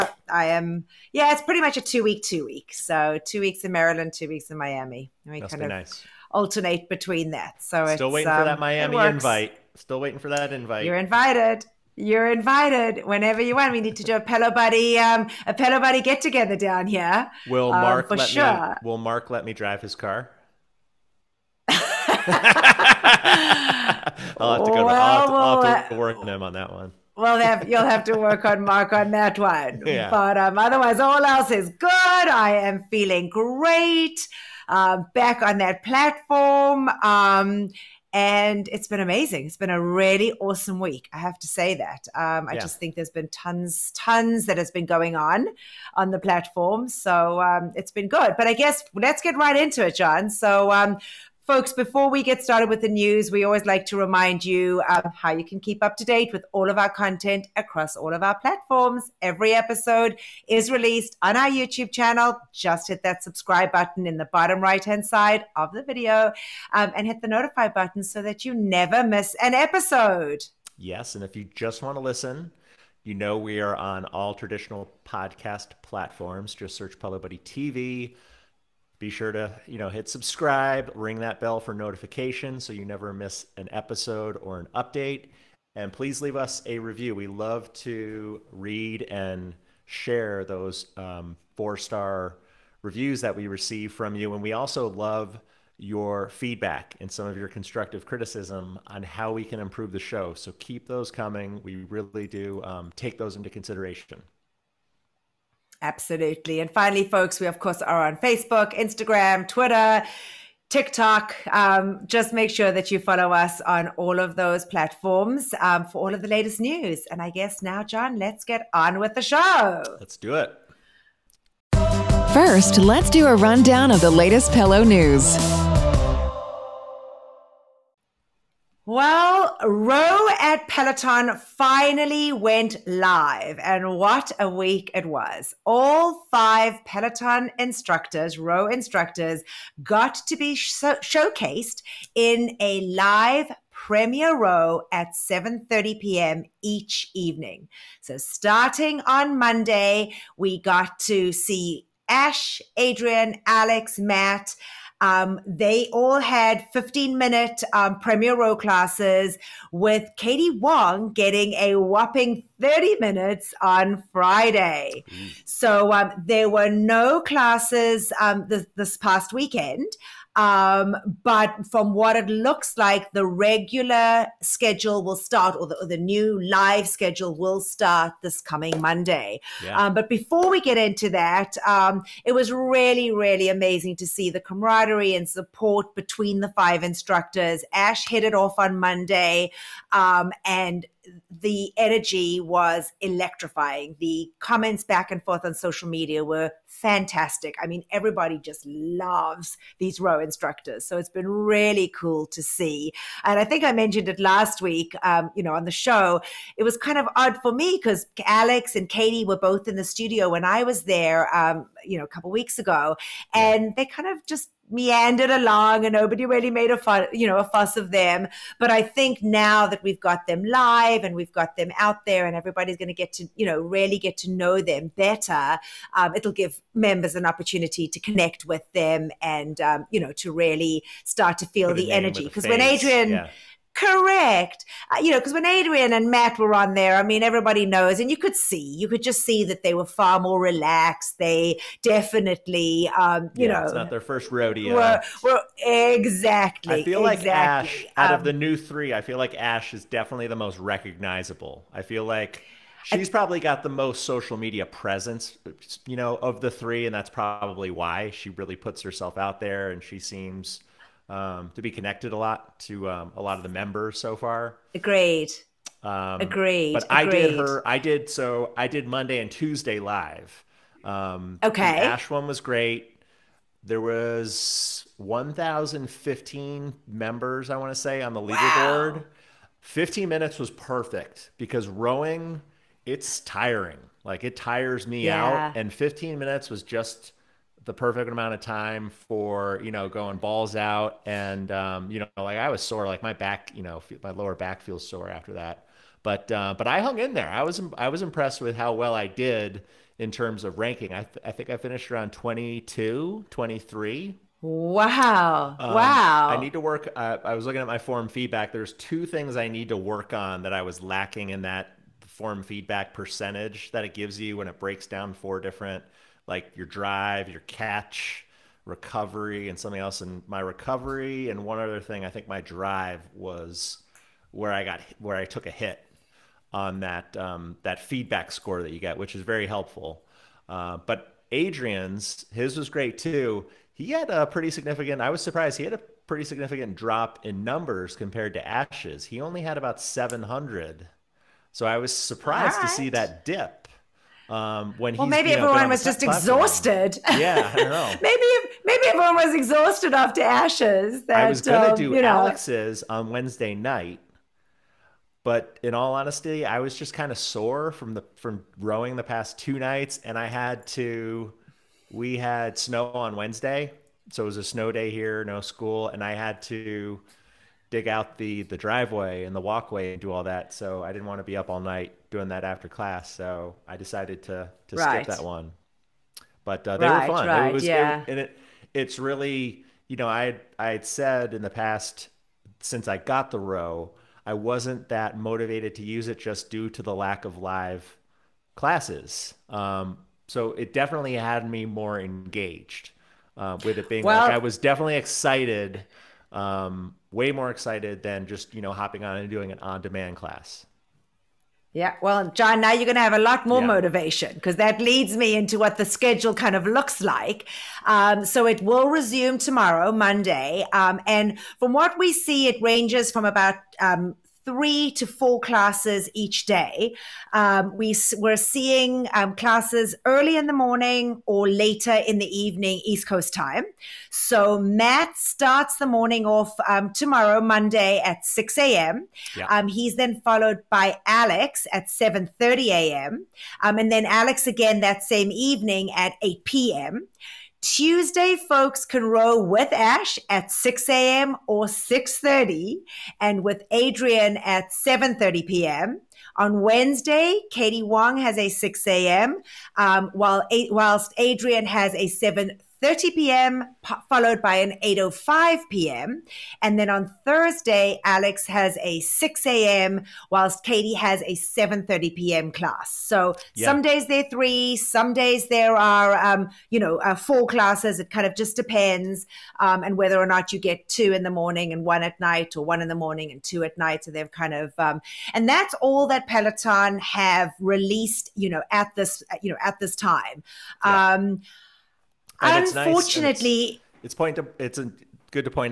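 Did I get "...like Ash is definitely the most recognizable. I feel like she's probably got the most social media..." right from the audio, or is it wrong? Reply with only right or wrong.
right.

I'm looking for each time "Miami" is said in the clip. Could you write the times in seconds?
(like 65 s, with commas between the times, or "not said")
4 s, 8 s.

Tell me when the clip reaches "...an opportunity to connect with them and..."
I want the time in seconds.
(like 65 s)
227 s.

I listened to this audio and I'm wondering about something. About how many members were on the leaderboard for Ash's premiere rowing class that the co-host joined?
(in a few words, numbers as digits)
1,015.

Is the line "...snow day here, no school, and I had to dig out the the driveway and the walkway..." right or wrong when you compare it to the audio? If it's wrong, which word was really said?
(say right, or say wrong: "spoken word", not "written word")
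right.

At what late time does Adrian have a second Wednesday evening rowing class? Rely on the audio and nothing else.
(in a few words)
8:05 p.m.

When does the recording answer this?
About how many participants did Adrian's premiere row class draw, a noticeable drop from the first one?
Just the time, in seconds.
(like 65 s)
339 s.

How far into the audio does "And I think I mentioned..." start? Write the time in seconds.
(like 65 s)
203 s.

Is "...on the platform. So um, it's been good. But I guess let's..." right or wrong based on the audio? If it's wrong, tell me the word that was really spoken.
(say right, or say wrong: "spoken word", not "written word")
right.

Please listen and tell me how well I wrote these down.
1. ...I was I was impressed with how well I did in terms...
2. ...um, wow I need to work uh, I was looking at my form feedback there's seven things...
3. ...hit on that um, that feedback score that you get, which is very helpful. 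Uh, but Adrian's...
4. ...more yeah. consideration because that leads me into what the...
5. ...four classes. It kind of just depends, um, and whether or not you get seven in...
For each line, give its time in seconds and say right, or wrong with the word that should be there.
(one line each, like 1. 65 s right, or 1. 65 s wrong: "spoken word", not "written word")
1. 297 s right
2. 305 s wrong: "two", not "seven"
3. 325 s right
4. 403 s wrong: "motivation", not "consideration"
5. 467 s wrong: "two", not "seven".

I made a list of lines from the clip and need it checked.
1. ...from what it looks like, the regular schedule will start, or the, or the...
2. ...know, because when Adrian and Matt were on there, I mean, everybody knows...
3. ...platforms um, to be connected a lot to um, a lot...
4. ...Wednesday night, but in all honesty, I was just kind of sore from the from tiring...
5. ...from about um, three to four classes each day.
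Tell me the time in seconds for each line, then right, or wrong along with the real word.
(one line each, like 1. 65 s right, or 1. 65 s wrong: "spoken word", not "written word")
1. 171 s right
2. 235 s right
3. 259 s wrong: "seems", not "platforms"
4. 353 s wrong: "rowing", not "tiring"
5. 413 s right.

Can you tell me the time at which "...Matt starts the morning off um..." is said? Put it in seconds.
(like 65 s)
424 s.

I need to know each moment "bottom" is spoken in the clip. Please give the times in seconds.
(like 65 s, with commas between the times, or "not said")
64 s.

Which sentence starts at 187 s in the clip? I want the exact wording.
Ash hit it off on Monday, um, and the energy was electrifying.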